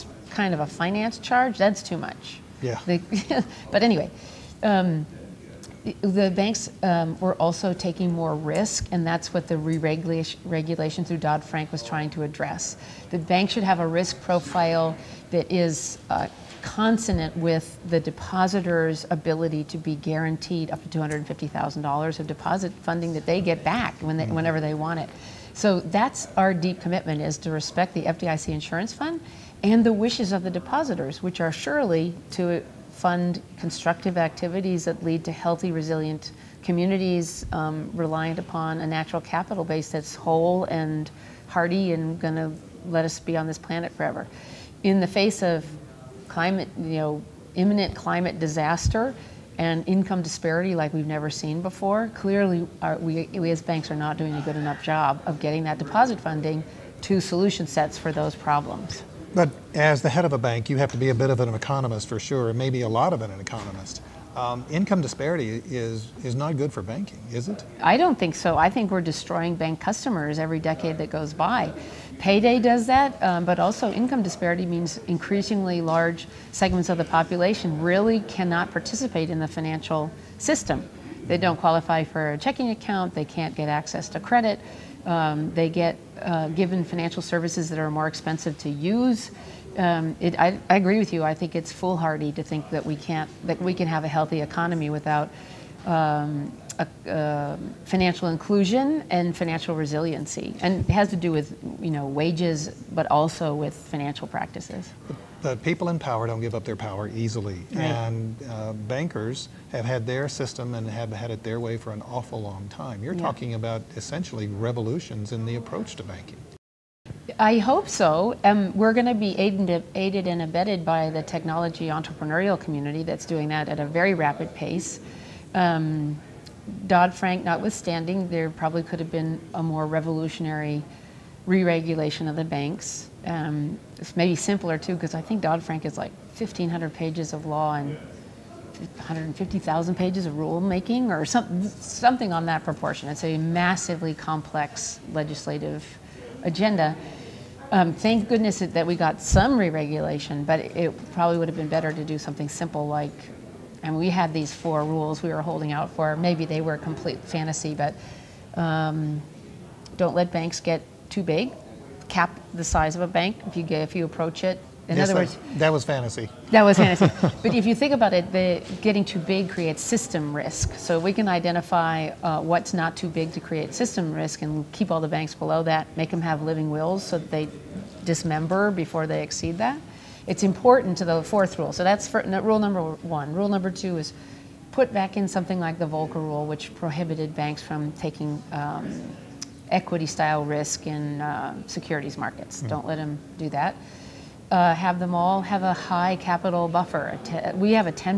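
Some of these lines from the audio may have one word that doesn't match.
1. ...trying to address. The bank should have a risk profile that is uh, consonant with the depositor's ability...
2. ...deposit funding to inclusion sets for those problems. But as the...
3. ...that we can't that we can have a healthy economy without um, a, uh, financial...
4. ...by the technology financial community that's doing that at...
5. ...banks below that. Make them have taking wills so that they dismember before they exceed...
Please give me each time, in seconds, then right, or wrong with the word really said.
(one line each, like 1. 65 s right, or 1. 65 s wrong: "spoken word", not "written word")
1. 11 s right
2. 55 s wrong: "solution", not "inclusion"
3. 92 s right
4. 120 s wrong: "entrepreneurial", not "financial"
5. 175 s wrong: "living", not "taking".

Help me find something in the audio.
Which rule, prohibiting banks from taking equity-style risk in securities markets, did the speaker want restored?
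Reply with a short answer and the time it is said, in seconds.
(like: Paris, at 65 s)
Volcker Rule, at 185 s.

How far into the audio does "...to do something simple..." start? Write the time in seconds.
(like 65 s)
151 s.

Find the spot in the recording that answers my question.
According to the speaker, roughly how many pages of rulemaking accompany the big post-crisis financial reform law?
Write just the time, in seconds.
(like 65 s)
138 s.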